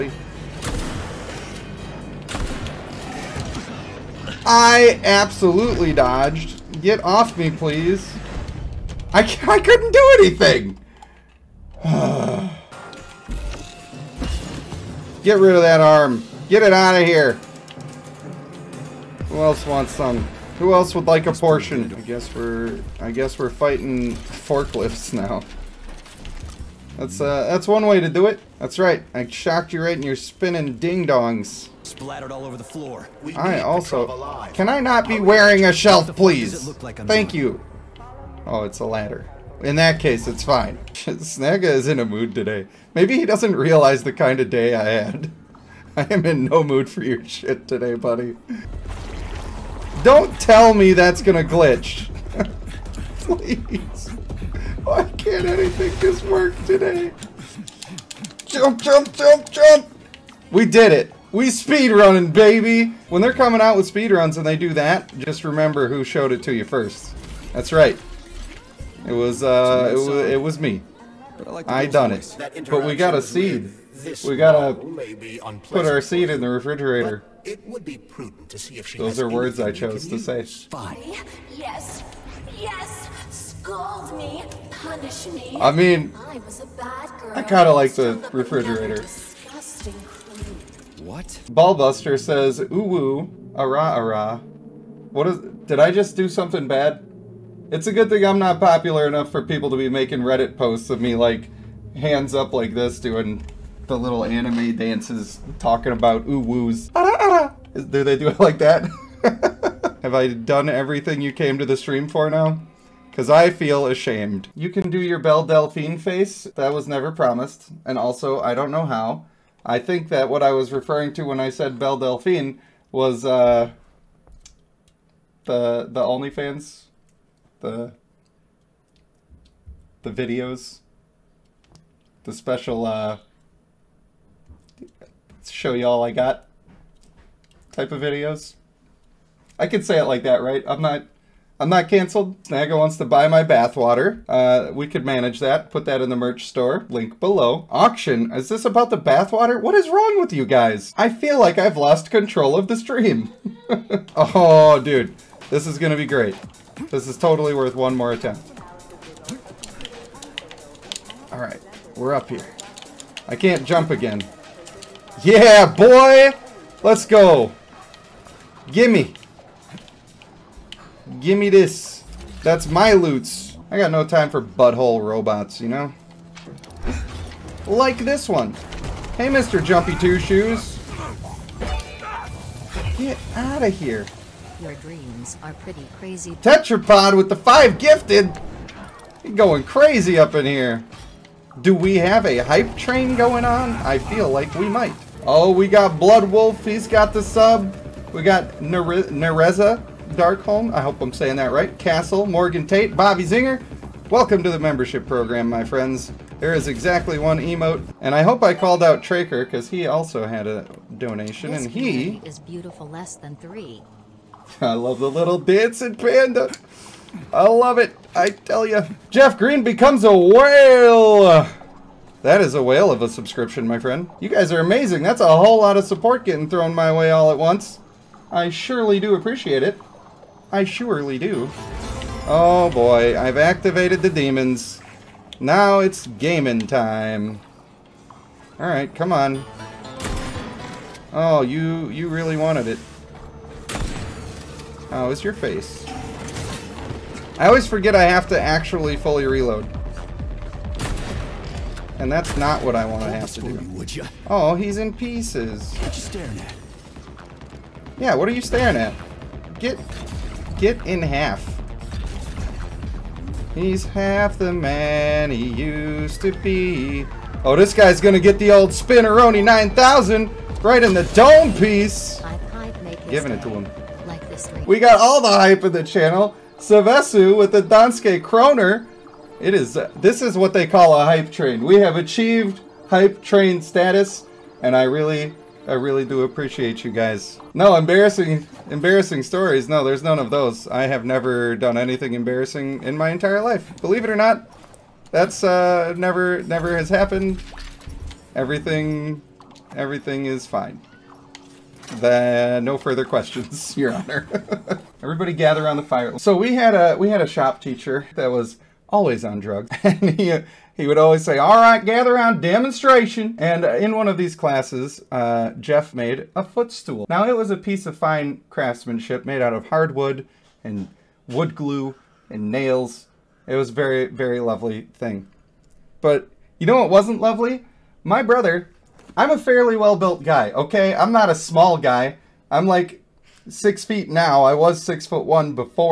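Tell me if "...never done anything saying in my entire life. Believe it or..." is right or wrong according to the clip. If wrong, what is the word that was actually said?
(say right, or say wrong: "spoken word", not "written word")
wrong: "embarrassing", not "saying".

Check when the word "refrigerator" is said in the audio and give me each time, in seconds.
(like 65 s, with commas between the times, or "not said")
76 s, 88 s.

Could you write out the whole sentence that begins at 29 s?
I shocked you right in your spinning ding dongs.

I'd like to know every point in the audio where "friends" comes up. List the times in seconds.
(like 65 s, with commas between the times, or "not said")
205 s, 223 s.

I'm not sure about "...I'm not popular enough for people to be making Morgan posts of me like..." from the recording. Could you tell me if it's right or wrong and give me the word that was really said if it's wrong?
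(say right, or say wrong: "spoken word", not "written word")
wrong: "Reddit", not "Morgan".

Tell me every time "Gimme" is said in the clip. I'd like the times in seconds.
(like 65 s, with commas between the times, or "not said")
168 s.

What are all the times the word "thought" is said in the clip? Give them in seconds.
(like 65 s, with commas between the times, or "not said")
not said.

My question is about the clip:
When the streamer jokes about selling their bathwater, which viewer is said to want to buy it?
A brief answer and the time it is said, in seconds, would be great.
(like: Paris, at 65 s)
Snagga, at 142 s.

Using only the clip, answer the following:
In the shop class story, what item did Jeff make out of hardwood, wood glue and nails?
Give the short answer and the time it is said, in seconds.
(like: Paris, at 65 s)
footstool, at 316 s.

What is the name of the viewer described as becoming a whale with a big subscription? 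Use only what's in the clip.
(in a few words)
Jeff Green.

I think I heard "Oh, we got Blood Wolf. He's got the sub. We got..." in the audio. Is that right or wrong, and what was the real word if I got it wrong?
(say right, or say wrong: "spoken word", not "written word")
right.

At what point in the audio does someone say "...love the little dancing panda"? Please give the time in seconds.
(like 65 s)
214 s.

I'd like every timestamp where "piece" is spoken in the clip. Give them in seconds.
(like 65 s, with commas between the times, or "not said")
254 s, 271 s, 317 s.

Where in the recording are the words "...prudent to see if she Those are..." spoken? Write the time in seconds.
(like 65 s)
77 s.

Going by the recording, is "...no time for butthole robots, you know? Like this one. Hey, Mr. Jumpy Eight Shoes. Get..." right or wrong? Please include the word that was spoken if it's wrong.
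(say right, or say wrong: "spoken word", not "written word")
wrong: "Two", not "Eight".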